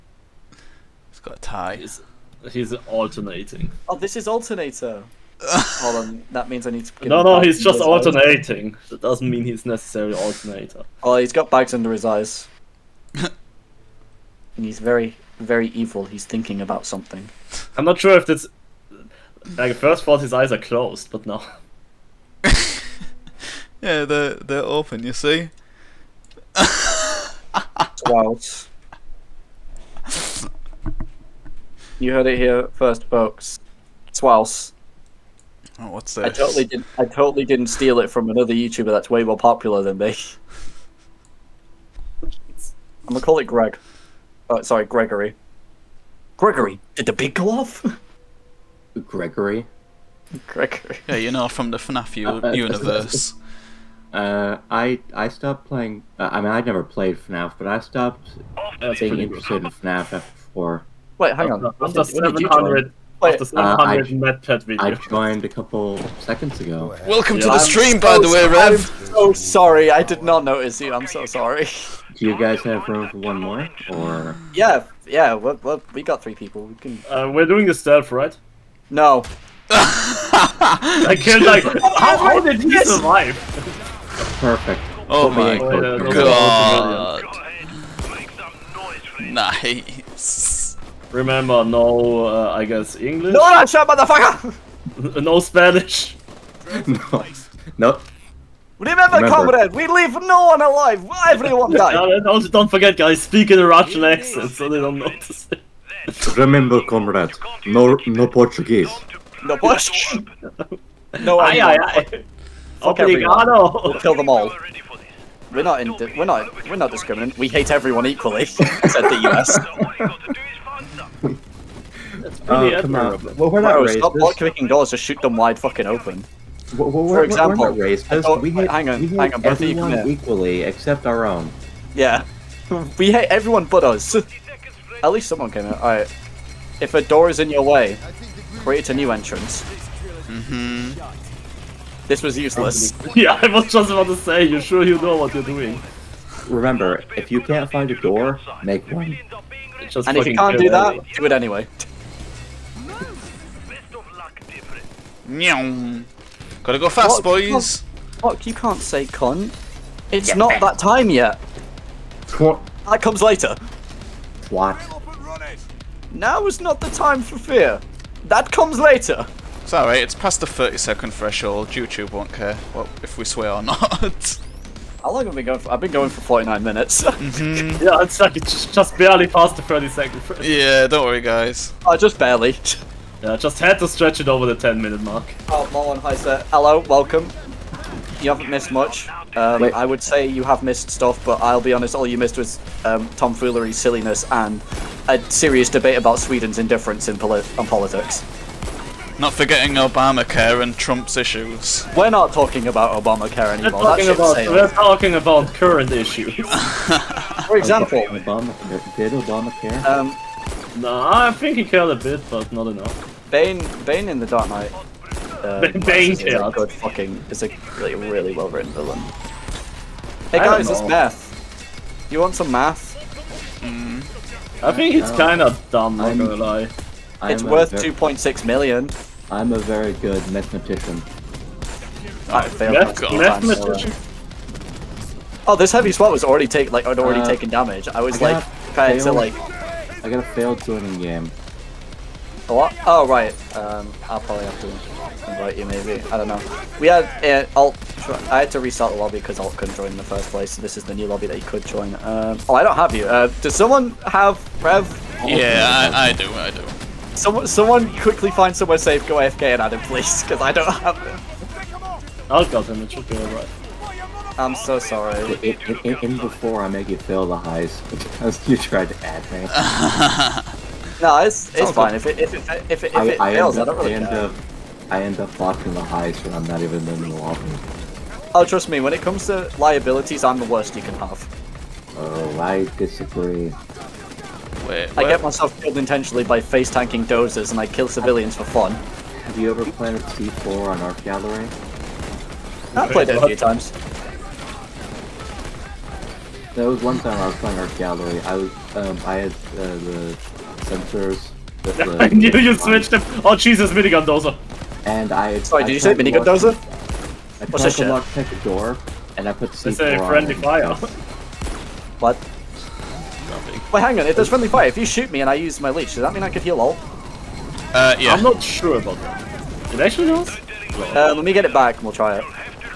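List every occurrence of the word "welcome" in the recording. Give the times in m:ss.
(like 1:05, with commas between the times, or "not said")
1:07, 3:06.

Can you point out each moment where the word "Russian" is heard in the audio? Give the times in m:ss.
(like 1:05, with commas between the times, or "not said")
1:43.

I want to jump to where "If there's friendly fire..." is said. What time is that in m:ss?
5:14.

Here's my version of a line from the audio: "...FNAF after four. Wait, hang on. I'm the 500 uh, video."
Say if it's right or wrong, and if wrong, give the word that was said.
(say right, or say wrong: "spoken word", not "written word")
wrong: "700", not "500".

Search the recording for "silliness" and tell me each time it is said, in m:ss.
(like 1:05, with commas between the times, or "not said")
3:13.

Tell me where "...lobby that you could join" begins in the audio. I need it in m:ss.
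4:11.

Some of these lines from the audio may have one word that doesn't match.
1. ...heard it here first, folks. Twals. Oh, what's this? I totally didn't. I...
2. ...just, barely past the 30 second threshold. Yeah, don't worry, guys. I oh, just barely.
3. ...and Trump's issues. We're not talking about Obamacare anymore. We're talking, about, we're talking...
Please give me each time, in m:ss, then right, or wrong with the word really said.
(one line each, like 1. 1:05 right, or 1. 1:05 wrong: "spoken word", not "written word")
1. 0:32 right
2. 2:58 right
3. 3:20 right.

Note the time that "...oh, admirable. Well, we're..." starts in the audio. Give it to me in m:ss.
2:02.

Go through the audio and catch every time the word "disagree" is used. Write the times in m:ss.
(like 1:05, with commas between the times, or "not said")
4:42.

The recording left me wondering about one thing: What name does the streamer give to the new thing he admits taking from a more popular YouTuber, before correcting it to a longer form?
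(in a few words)
Greg.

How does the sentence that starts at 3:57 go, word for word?
I was I like trying to like.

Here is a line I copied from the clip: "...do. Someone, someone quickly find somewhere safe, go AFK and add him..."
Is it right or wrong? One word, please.
right.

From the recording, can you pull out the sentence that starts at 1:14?
Yeah, yeah, we we got three people.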